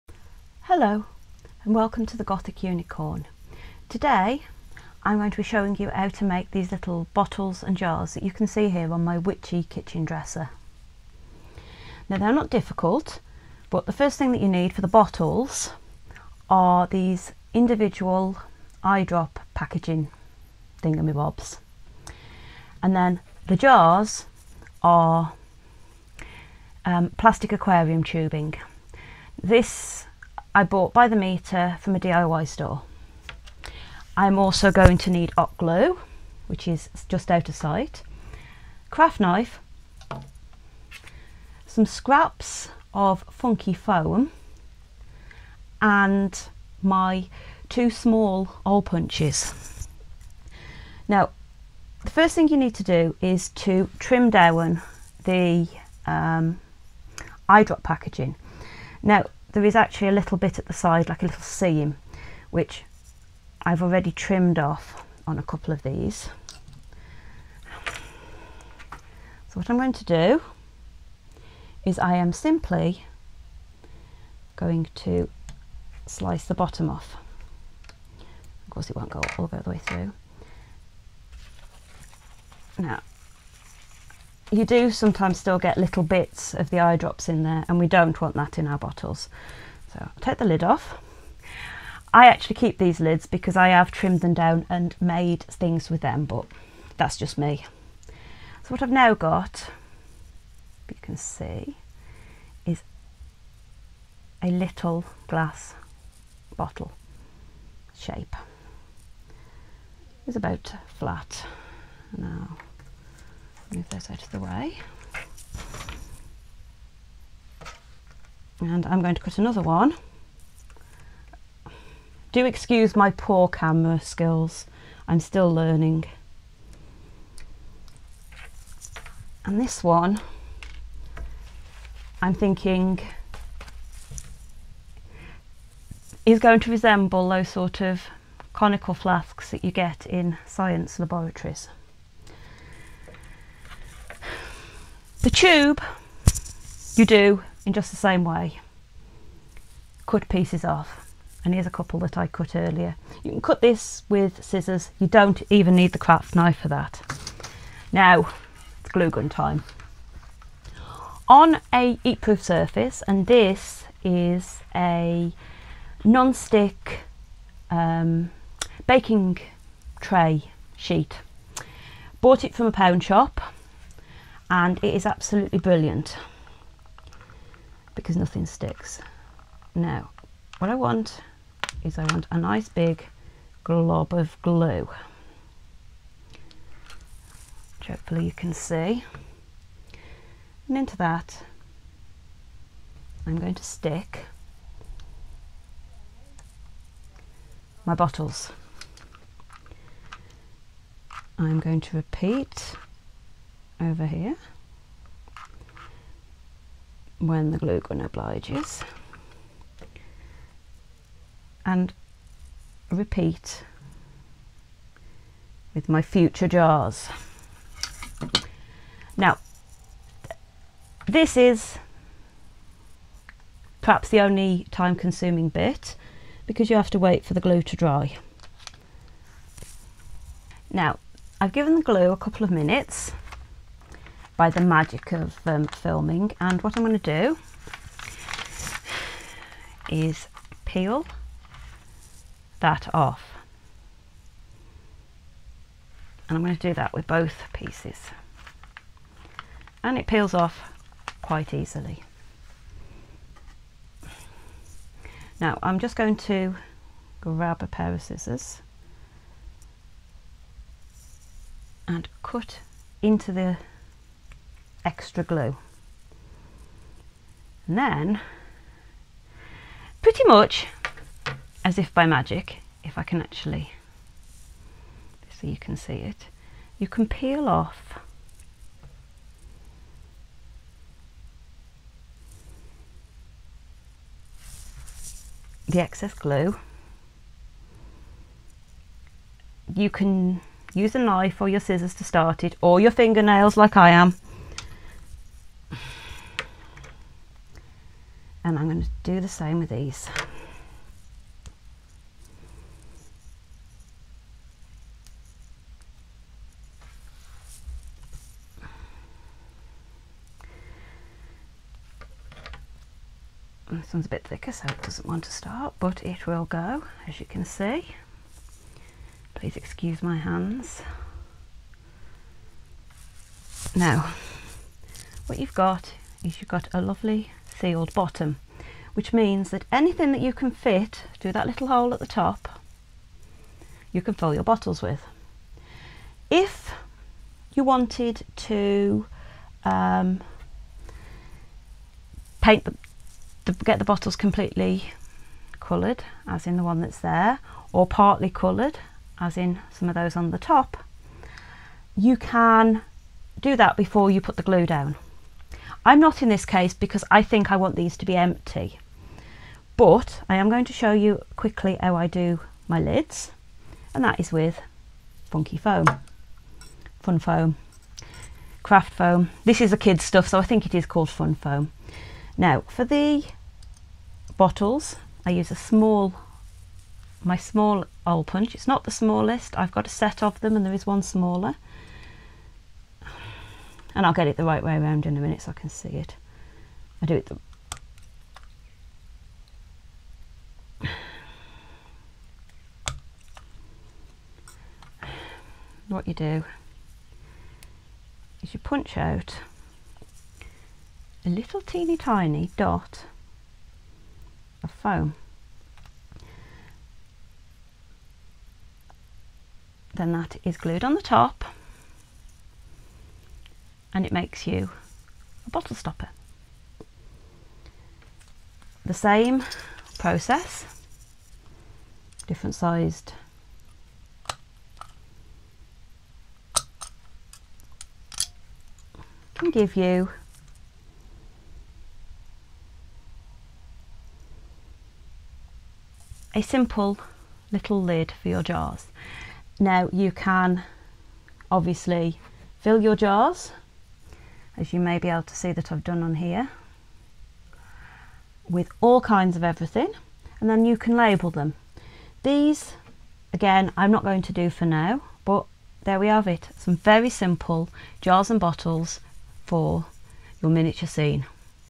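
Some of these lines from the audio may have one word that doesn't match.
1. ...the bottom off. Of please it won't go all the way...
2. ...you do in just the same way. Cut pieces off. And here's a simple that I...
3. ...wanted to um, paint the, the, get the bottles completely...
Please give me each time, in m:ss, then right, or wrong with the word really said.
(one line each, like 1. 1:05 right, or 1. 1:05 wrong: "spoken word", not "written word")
1. 1:16 wrong: "course", not "please"
2. 2:26 wrong: "couple", not "simple"
3. 5:37 right.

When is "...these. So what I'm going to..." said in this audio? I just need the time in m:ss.
1:05.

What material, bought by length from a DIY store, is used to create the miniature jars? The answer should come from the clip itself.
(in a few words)
plastic aquarium tubing.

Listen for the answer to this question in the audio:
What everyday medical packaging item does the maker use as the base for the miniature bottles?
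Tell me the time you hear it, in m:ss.
0:18.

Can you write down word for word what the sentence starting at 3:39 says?
Now, this is perhaps the only time consuming bit because you have to wait for the glue to dry.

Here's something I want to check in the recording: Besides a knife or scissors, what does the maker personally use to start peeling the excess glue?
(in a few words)
fingernails.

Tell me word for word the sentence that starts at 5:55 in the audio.
I'm not in this case because I think I want these to be empty.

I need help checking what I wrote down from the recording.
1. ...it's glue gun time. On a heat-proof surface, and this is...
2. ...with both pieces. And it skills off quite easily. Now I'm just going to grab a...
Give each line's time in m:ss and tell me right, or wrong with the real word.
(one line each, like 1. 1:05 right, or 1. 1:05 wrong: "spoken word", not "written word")
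1. 2:38 right
2. 4:06 wrong: "peels", not "skills".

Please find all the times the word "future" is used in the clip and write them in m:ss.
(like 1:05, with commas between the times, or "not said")
3:36.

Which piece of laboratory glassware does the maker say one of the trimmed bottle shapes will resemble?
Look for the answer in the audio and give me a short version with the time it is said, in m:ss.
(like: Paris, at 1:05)
conical flasks, at 2:18.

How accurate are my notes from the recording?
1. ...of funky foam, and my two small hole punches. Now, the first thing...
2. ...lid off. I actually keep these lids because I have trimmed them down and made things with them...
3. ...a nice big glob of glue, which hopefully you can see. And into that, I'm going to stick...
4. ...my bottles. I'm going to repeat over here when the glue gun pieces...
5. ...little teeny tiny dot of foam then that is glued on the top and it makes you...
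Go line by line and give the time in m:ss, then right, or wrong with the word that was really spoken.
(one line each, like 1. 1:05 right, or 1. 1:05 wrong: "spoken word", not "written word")
1. 0:42 right
2. 1:30 right
3. 3:02 right
4. 3:17 wrong: "obliges", not "pieces"
5. 6:41 right.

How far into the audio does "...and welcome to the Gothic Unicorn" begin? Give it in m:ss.
0:01.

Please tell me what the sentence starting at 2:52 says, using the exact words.
Bought it from a pound shop and it is absolutely brilliant because nothing sticks.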